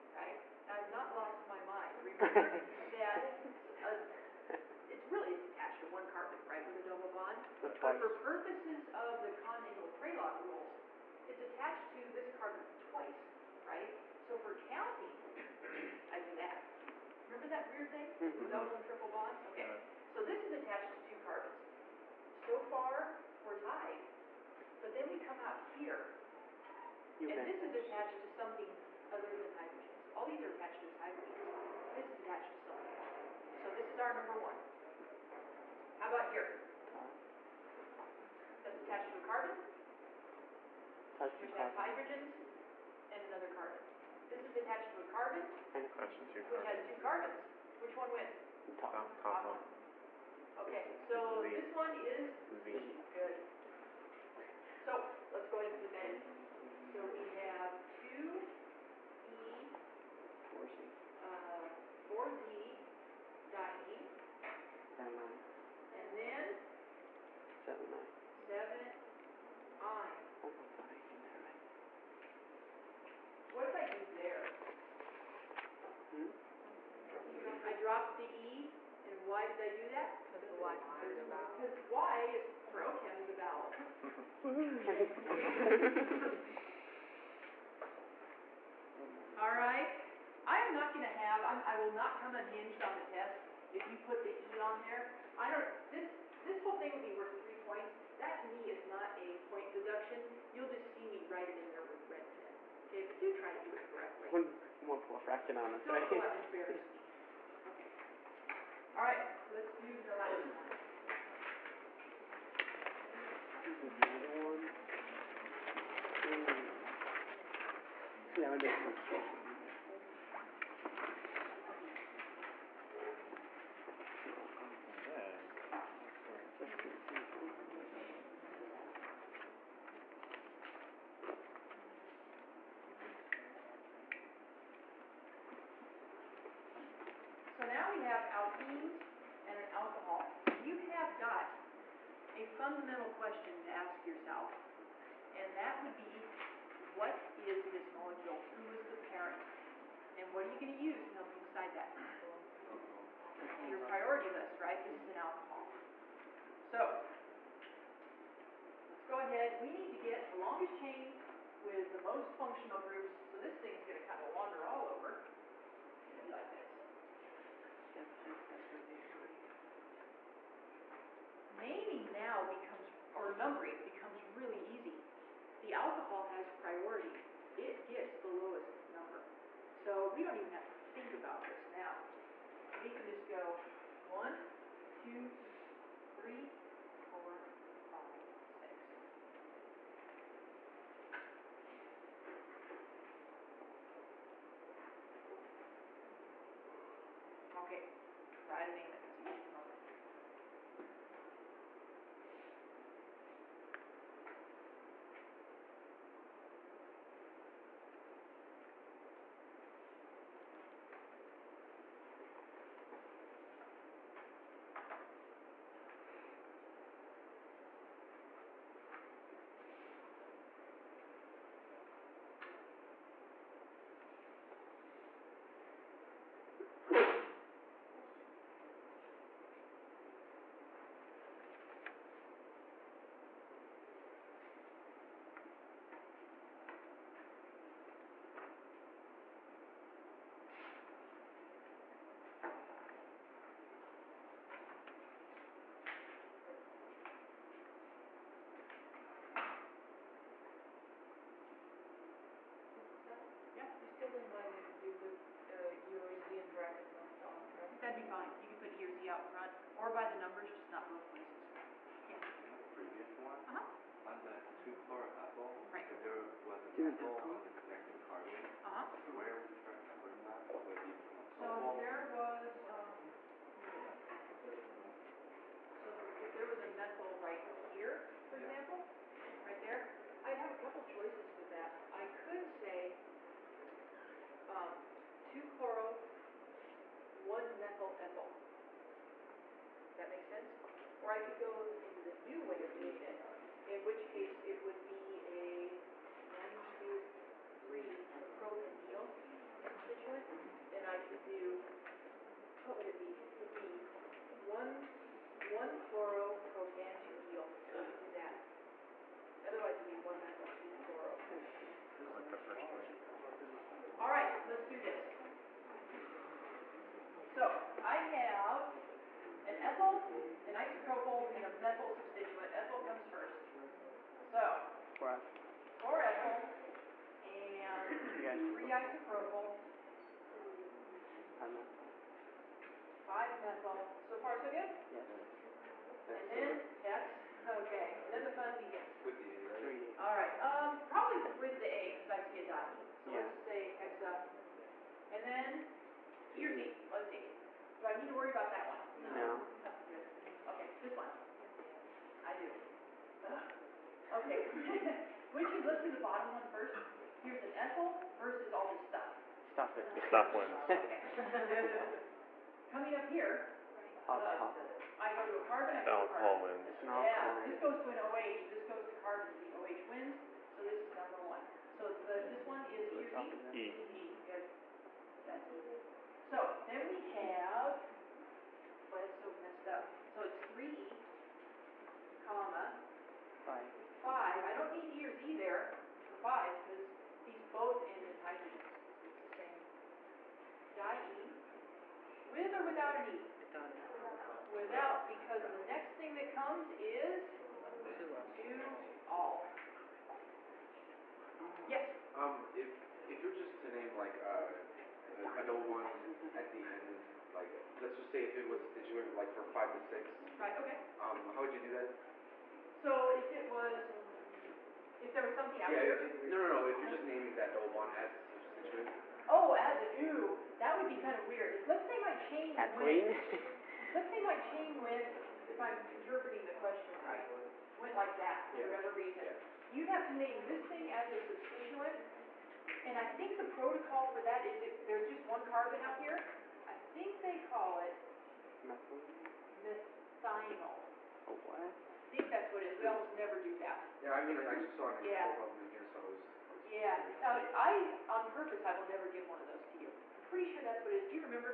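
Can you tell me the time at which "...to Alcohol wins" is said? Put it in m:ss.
6:05.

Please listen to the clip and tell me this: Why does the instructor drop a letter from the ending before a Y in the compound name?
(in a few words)
Y is considered a vowel.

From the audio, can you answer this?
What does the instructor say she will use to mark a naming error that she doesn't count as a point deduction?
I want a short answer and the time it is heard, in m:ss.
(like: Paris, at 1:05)
Red pen, at 1:42.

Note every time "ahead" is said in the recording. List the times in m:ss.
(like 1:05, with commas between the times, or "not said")
0:55, 2:39.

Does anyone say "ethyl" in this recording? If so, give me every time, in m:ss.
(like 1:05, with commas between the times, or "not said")
4:26, 5:57.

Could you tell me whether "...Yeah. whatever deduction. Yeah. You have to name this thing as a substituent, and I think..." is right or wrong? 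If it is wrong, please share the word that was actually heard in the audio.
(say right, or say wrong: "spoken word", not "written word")
wrong: "reason", not "deduction".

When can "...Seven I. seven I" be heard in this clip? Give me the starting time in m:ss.
1:07.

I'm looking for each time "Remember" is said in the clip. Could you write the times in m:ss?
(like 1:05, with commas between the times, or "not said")
0:02, 0:17.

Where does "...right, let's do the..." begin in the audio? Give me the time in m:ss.
1:49.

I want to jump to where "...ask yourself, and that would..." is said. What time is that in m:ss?
2:23.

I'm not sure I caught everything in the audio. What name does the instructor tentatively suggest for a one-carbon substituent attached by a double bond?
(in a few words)
Methinol.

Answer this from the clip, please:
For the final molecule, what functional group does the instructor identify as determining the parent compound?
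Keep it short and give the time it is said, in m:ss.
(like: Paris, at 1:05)
An alcohol, at 2:34.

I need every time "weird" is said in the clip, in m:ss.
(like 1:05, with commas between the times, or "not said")
0:17, 7:01.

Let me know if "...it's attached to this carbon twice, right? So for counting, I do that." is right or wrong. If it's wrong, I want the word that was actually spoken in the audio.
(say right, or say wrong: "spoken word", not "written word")
right.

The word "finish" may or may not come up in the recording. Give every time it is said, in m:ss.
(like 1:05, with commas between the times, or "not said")
not said.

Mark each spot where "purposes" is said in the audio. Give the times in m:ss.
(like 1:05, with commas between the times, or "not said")
0:08, 7:28.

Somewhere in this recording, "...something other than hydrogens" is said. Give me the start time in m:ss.
0:28.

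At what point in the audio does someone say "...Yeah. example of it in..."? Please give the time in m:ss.
7:25.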